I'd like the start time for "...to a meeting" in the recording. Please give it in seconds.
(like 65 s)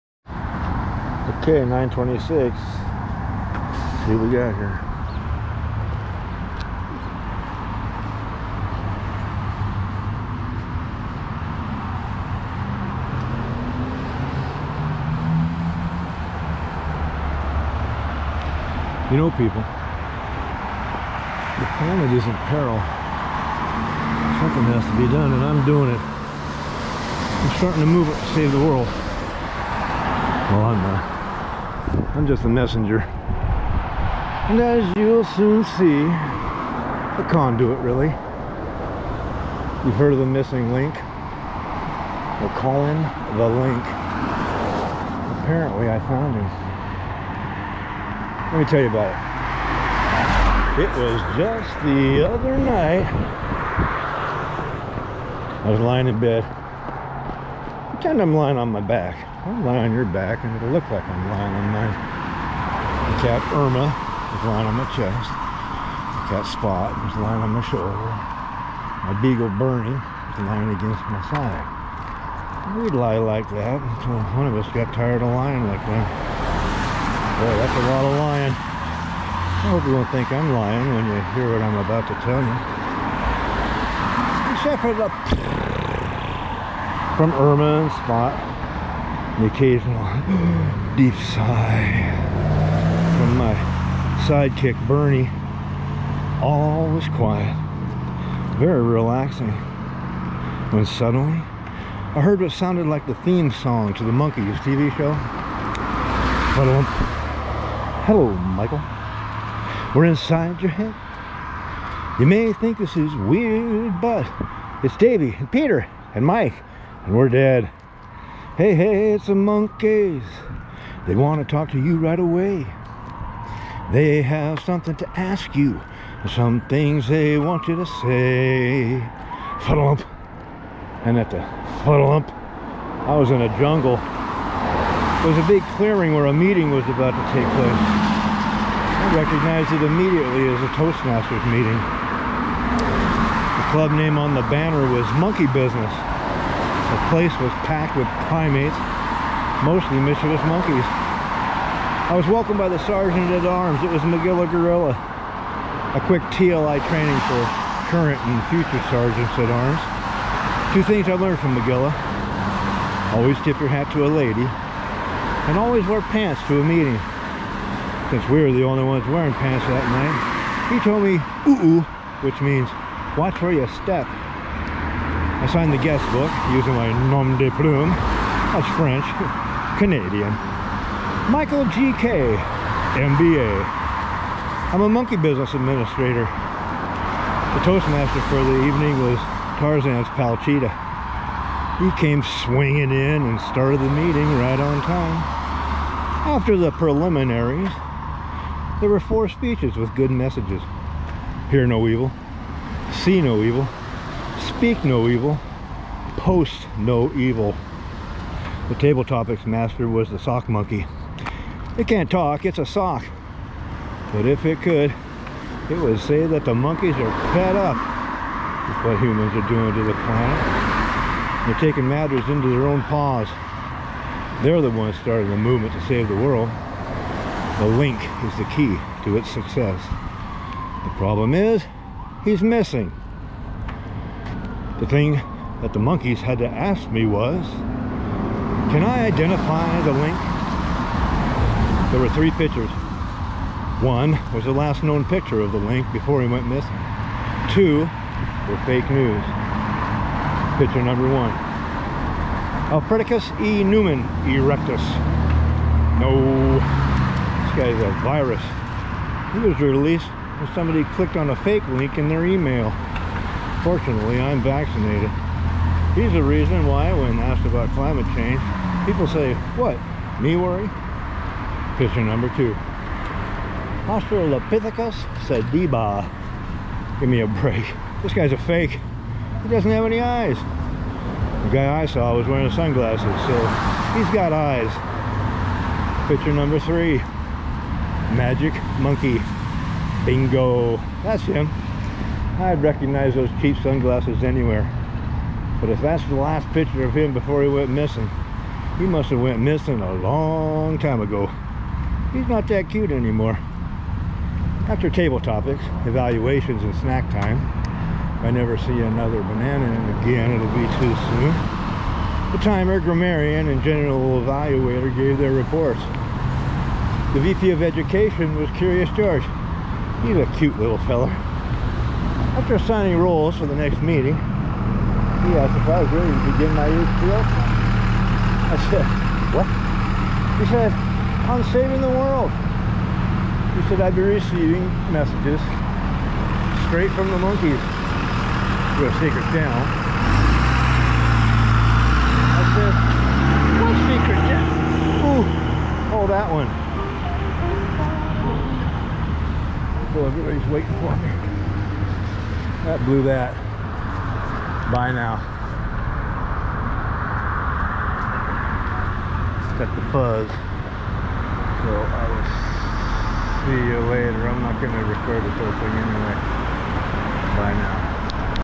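166 s.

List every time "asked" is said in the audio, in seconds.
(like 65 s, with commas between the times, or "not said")
267 s, 325 s.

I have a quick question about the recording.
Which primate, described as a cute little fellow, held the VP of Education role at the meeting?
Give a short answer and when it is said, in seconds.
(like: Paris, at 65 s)
Curious George, at 318 s.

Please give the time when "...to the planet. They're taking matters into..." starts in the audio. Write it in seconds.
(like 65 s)
219 s.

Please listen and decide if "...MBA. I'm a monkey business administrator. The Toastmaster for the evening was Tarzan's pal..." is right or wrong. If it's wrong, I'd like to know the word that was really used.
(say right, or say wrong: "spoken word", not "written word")
right.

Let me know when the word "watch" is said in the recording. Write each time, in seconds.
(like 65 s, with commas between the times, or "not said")
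173 s.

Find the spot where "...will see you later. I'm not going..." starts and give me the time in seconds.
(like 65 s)
363 s.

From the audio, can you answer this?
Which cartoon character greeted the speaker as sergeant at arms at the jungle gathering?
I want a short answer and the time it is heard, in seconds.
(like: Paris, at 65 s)
Magilla Gorilla, at 154 s.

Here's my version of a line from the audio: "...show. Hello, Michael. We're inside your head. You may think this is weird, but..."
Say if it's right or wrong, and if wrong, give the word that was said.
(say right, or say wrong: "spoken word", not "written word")
right.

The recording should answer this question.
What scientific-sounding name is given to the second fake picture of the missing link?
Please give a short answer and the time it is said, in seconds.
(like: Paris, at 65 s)
Australopithecus sediba, at 273 s.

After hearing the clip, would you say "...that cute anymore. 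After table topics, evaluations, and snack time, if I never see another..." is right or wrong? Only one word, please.
right.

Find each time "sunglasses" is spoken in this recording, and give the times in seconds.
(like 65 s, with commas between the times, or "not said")
282 s, 293 s.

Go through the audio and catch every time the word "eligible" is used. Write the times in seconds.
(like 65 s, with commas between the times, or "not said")
not said.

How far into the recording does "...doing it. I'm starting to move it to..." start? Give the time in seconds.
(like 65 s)
25 s.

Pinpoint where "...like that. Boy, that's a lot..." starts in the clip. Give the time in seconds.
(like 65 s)
75 s.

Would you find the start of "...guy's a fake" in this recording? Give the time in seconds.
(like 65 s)
278 s.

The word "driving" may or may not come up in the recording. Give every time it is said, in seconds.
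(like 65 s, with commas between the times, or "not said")
not said.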